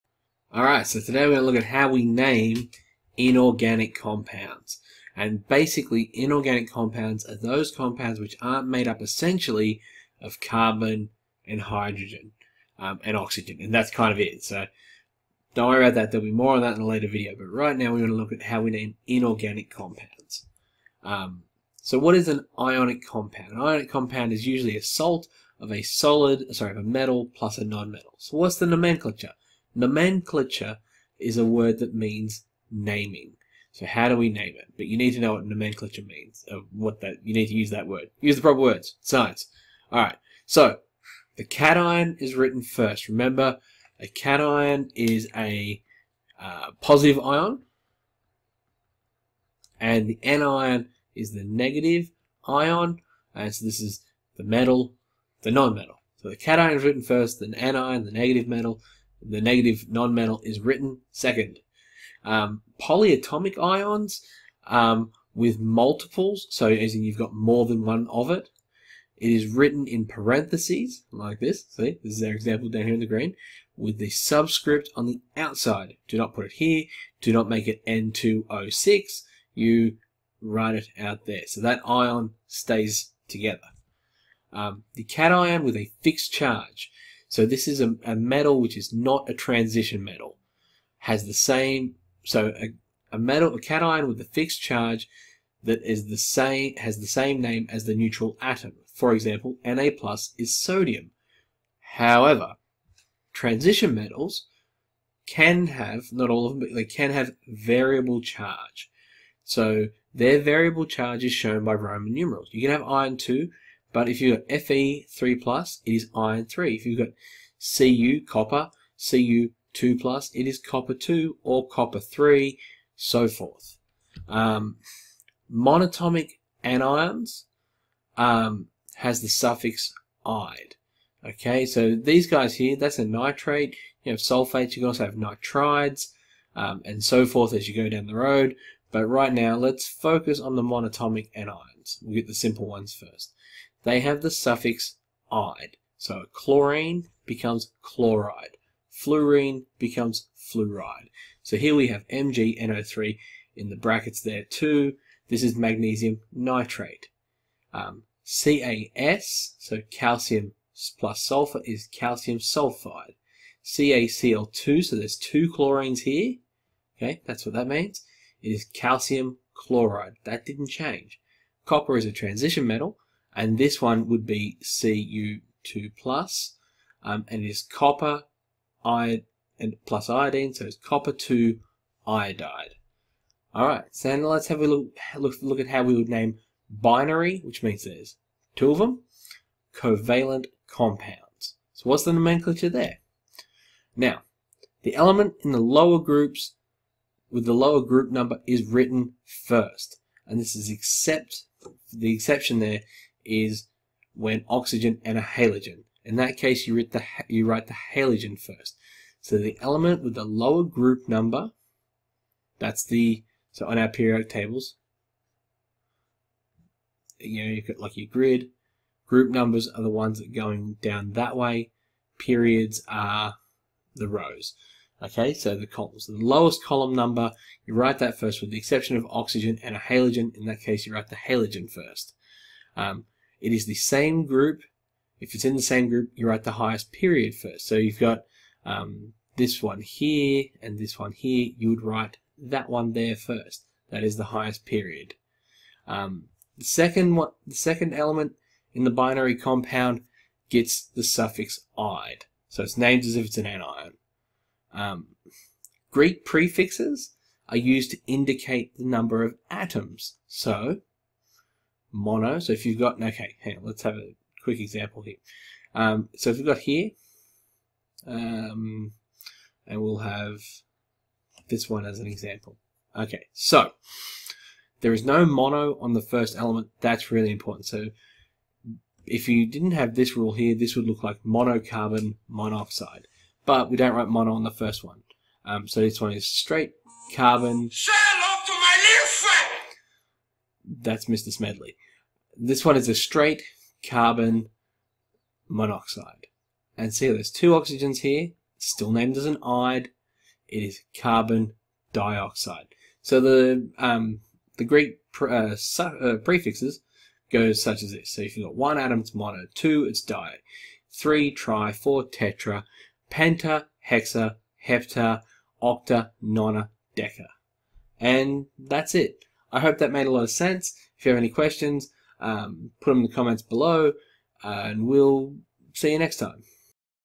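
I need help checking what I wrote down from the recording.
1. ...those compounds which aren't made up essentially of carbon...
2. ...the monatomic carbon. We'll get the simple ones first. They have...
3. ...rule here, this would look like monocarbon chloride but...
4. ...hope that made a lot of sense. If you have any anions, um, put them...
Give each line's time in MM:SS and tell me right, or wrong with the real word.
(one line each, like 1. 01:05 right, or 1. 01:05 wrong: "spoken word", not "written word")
1. 00:07 right
2. 02:20 wrong: "anion", not "carbon"
3. 04:40 wrong: "monoxide", not "chloride"
4. 05:19 wrong: "questions", not "anions".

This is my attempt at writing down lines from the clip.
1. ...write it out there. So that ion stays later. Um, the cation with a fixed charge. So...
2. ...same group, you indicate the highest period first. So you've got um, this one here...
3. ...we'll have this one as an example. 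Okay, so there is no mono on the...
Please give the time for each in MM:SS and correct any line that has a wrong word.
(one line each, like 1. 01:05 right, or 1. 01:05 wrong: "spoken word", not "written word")
1. 01:20 wrong: "together", not "later"
2. 03:55 wrong: "write", not "indicate"
3. 04:29 right.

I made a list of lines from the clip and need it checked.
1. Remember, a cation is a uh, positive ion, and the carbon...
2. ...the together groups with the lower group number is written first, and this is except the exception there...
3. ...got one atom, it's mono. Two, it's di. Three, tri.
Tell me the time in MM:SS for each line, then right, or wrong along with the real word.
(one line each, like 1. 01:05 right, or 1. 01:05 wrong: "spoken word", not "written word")
1. 00:43 wrong: "anion", not "carbon"
2. 03:15 wrong: "lower", not "together"
3. 05:08 right.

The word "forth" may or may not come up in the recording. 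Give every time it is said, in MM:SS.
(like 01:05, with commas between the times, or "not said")
02:03, 02:17.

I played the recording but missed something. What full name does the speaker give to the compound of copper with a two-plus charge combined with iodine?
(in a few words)
Copper 2 iodide.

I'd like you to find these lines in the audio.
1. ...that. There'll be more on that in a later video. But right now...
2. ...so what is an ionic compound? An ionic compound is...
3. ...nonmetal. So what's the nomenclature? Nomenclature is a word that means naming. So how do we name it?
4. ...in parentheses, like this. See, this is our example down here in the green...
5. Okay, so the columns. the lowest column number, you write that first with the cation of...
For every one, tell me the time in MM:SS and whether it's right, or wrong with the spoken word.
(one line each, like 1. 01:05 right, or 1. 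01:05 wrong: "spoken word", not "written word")
1. 00:15 right
2. 00:21 right
3. 00:27 right
4. 01:09 right
5. 03:45 wrong: "exception", not "cation".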